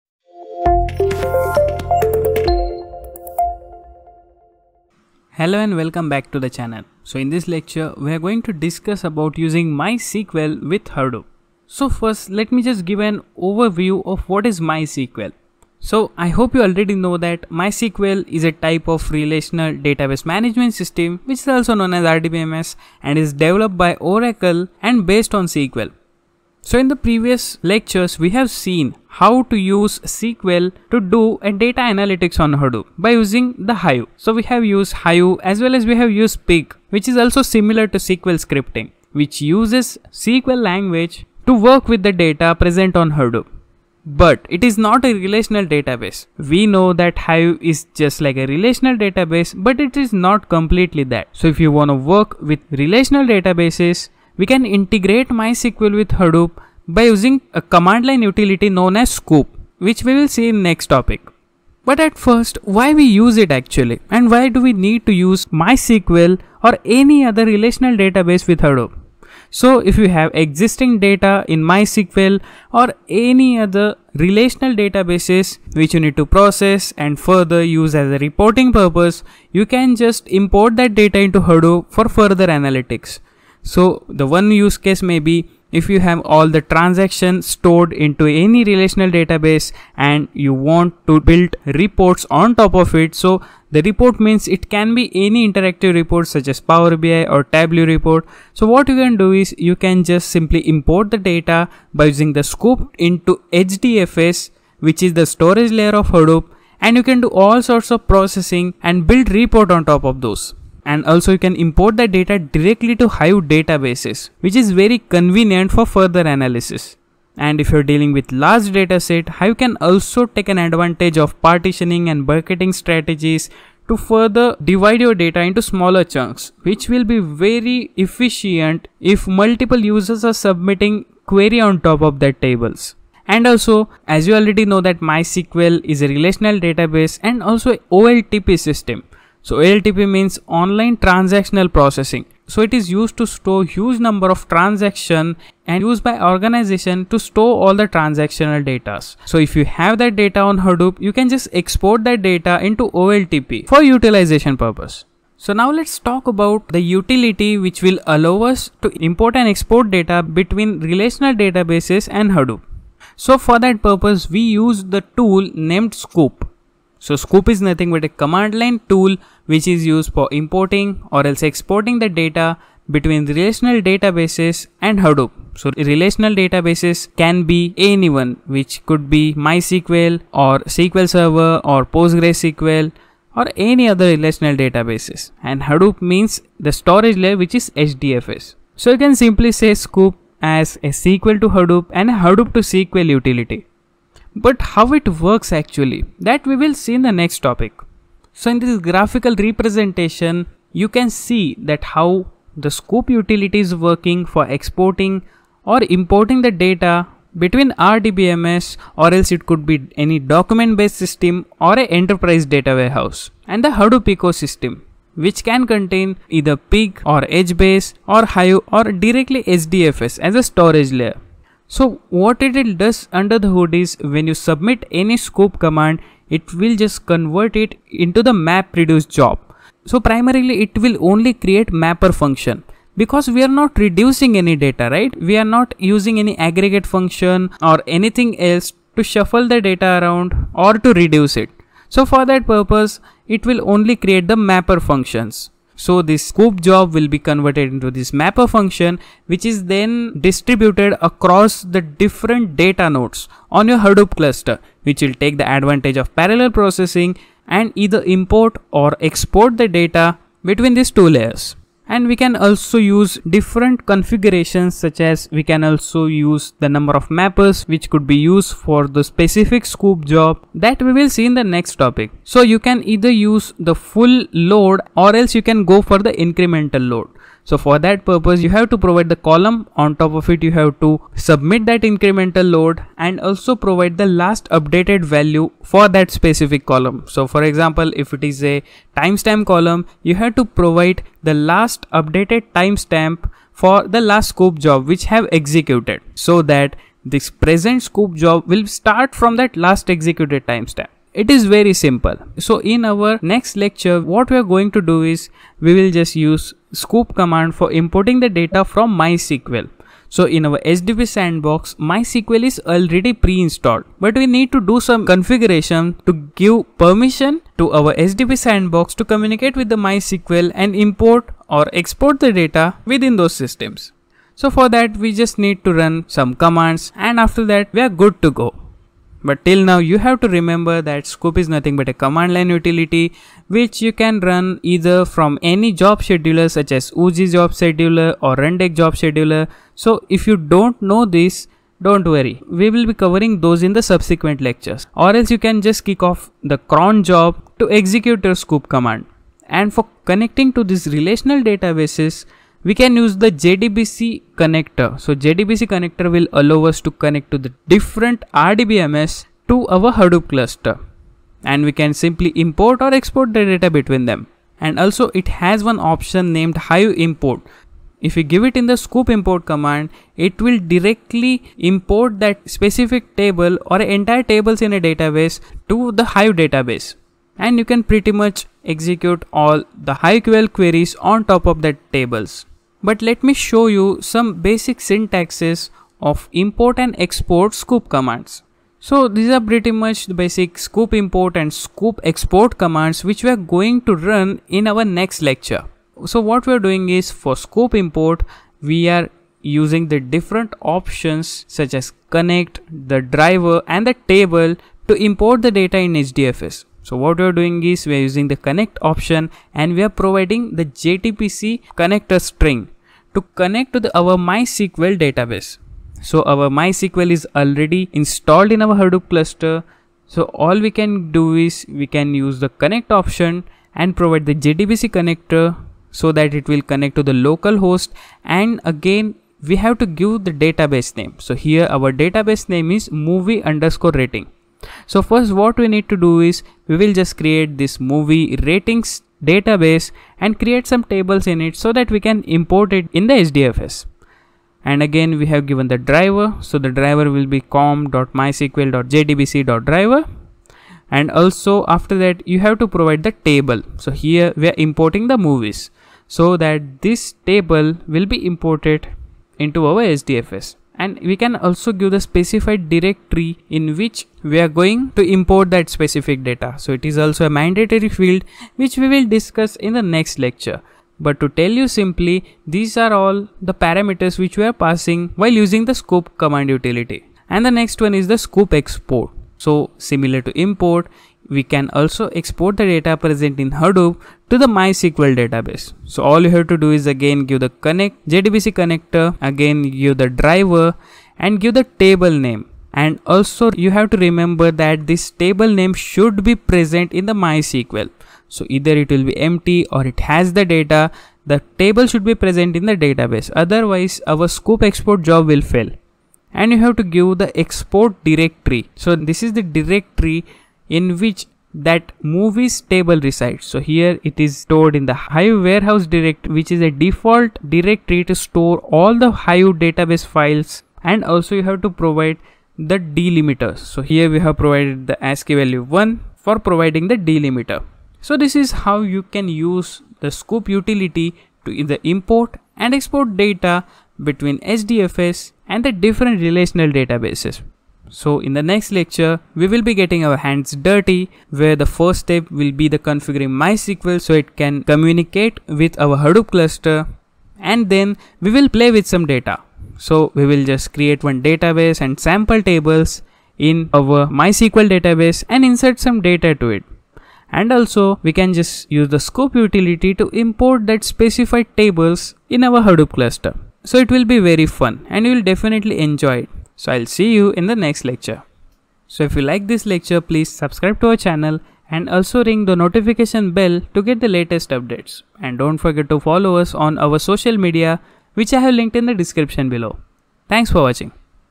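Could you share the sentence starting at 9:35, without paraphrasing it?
And don't forget to follow us on our social media which I have linked in the description below.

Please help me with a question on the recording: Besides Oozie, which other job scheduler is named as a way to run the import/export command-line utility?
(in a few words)
Rundeck.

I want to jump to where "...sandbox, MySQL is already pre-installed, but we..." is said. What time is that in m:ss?
5:11.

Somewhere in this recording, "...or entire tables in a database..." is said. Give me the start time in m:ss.
6:13.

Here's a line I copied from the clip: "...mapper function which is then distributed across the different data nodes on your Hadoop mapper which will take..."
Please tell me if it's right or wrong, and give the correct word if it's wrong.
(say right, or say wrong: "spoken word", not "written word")
wrong: "cluster", not "mapper".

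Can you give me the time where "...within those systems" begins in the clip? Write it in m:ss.
5:22.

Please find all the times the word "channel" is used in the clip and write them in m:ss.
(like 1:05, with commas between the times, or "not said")
0:06, 9:31.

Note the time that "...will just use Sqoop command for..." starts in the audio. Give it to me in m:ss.
5:05.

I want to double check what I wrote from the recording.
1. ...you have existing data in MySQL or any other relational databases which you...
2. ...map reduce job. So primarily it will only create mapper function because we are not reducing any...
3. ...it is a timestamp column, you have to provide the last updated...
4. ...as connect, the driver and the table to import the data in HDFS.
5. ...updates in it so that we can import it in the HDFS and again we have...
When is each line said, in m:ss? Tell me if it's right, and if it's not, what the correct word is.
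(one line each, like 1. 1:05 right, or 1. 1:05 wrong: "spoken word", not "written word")
1. 1:09 right
2. 3:48 right
3. 4:48 right
4. 6:41 right
5. 7:20 wrong: "tables", not "updates".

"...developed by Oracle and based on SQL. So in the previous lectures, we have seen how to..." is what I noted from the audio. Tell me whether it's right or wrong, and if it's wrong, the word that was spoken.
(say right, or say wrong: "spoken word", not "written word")
right.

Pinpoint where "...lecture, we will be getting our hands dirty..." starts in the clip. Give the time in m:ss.
8:58.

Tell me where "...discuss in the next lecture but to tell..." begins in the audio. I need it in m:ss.
7:49.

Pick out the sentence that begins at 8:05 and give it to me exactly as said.
So all you have to do is again give the connect JDBC connector, again give the driver and give the table name.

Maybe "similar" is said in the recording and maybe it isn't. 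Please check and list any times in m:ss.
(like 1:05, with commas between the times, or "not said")
0:37, 7:59.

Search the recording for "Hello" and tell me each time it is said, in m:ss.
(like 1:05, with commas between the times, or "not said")
0:05.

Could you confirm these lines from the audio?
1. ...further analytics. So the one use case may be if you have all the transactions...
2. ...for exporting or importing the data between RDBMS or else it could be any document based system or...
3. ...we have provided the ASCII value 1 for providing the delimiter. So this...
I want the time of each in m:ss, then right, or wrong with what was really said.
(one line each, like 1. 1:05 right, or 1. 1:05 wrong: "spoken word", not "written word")
1. 1:22 right
2. 3:24 right
3. 8:44 right.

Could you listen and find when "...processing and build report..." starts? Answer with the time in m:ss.
1:48.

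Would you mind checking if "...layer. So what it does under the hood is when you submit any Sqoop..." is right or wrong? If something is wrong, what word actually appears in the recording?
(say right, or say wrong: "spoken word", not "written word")
right.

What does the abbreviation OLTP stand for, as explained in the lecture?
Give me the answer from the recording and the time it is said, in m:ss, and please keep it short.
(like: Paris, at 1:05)
Online transactional processing, at 2:20.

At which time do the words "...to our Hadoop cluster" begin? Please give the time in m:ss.
5:59.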